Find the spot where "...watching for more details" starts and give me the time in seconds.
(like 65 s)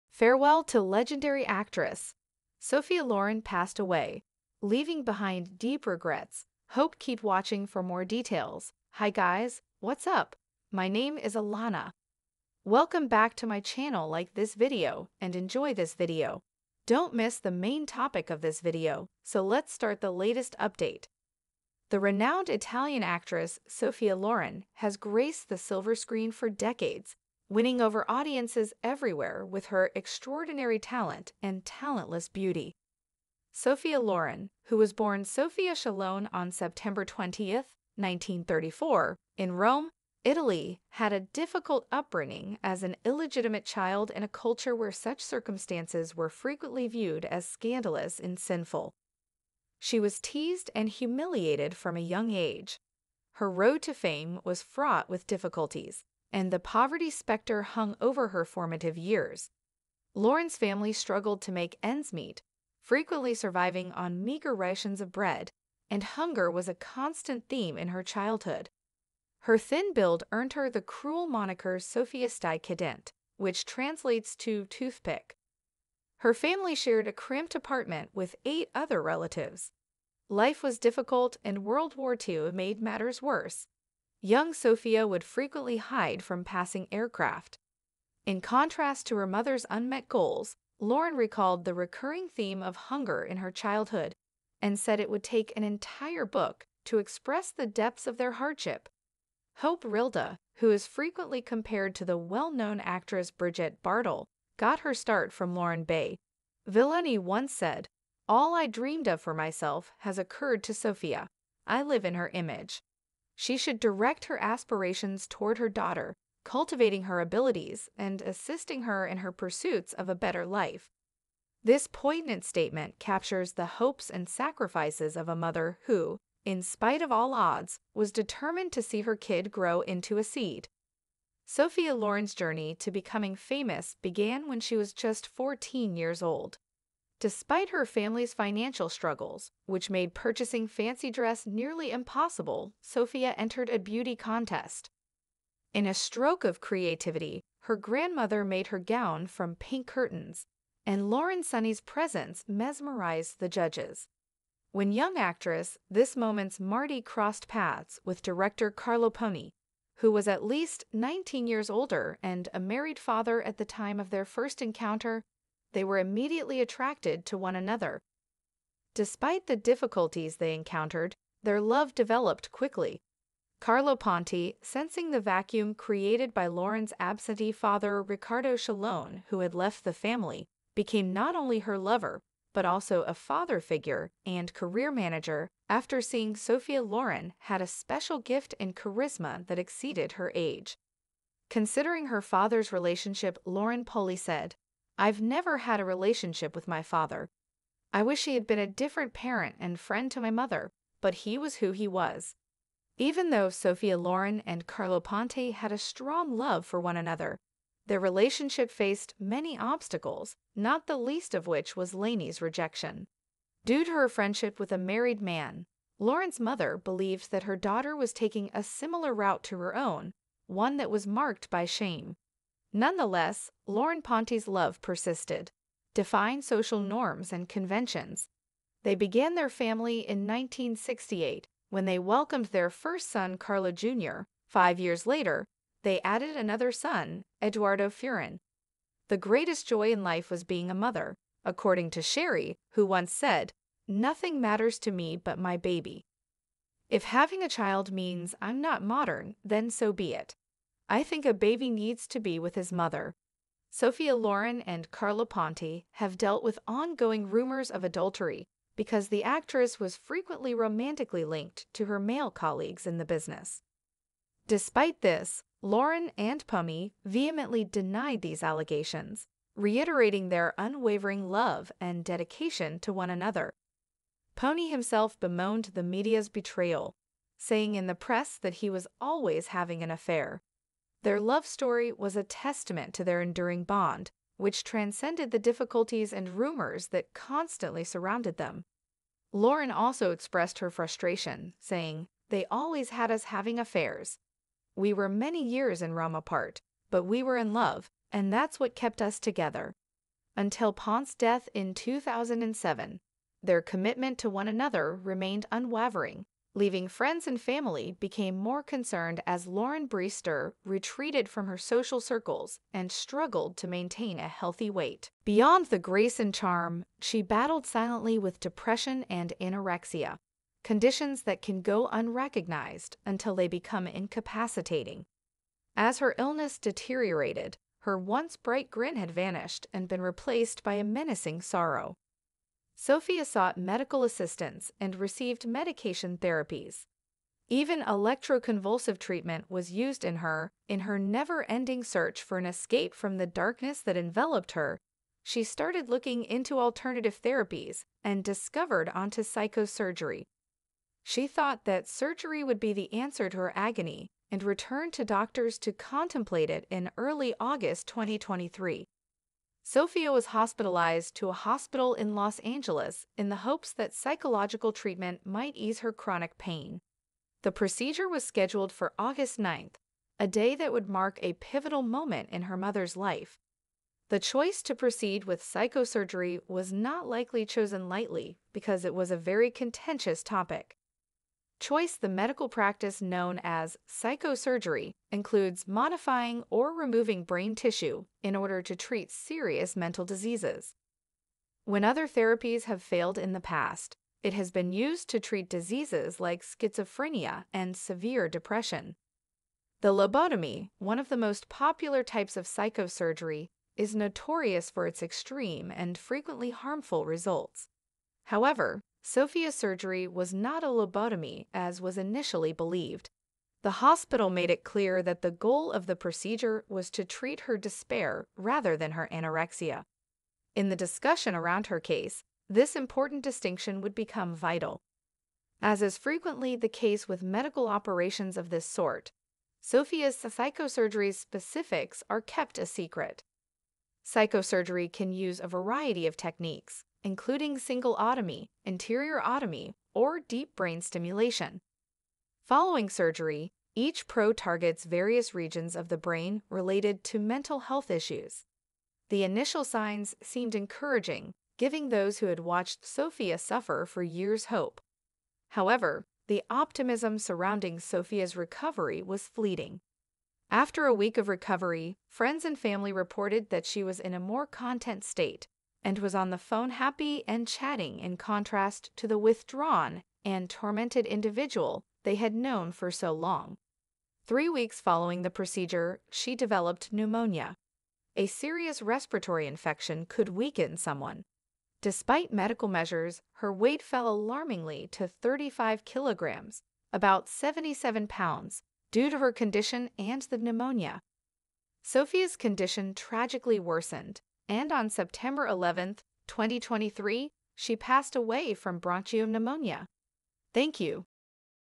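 7 s.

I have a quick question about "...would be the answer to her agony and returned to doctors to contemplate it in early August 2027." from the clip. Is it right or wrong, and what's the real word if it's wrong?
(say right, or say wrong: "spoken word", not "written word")
wrong: "2023", not "2027".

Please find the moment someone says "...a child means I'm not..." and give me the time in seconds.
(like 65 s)
247 s.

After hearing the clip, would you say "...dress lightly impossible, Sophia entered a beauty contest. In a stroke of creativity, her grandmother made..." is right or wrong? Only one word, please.
wrong.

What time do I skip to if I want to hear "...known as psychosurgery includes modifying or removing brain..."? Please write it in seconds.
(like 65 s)
383 s.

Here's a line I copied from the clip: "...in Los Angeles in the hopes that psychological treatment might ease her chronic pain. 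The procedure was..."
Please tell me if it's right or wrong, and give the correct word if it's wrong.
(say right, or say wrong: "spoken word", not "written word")
right.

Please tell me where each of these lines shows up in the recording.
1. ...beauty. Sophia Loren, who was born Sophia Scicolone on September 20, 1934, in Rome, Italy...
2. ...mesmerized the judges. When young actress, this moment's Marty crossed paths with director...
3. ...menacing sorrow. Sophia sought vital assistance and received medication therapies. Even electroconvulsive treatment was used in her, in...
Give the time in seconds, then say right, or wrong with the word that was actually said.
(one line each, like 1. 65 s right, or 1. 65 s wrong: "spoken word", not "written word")
1. 32 s right
2. 152 s right
3. 330 s wrong: "medical", not "vital".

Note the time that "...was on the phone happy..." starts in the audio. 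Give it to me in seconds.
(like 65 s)
465 s.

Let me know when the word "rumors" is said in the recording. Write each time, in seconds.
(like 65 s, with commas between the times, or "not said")
257 s, 286 s.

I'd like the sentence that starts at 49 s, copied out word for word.
She was teased and humiliated from a young age.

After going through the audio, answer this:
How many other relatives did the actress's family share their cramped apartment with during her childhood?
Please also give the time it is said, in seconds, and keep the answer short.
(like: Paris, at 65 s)
8, at 78 s.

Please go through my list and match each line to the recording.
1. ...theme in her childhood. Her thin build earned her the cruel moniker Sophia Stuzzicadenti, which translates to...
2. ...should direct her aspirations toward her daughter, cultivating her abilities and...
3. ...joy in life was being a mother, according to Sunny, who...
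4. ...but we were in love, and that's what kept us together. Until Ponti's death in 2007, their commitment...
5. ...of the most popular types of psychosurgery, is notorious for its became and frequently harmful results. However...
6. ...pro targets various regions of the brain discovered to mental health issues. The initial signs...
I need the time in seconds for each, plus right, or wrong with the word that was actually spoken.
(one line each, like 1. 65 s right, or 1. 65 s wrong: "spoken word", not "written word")
1. 67 s right
2. 113 s right
3. 239 s wrong: "Sherry", not "Sunny"
4. 296 s right
5. 400 s wrong: "extreme", not "became"
6. 444 s wrong: "related", not "discovered".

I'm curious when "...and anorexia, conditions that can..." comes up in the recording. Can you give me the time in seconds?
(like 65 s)
319 s.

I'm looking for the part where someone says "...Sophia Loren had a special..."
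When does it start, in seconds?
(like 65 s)
186 s.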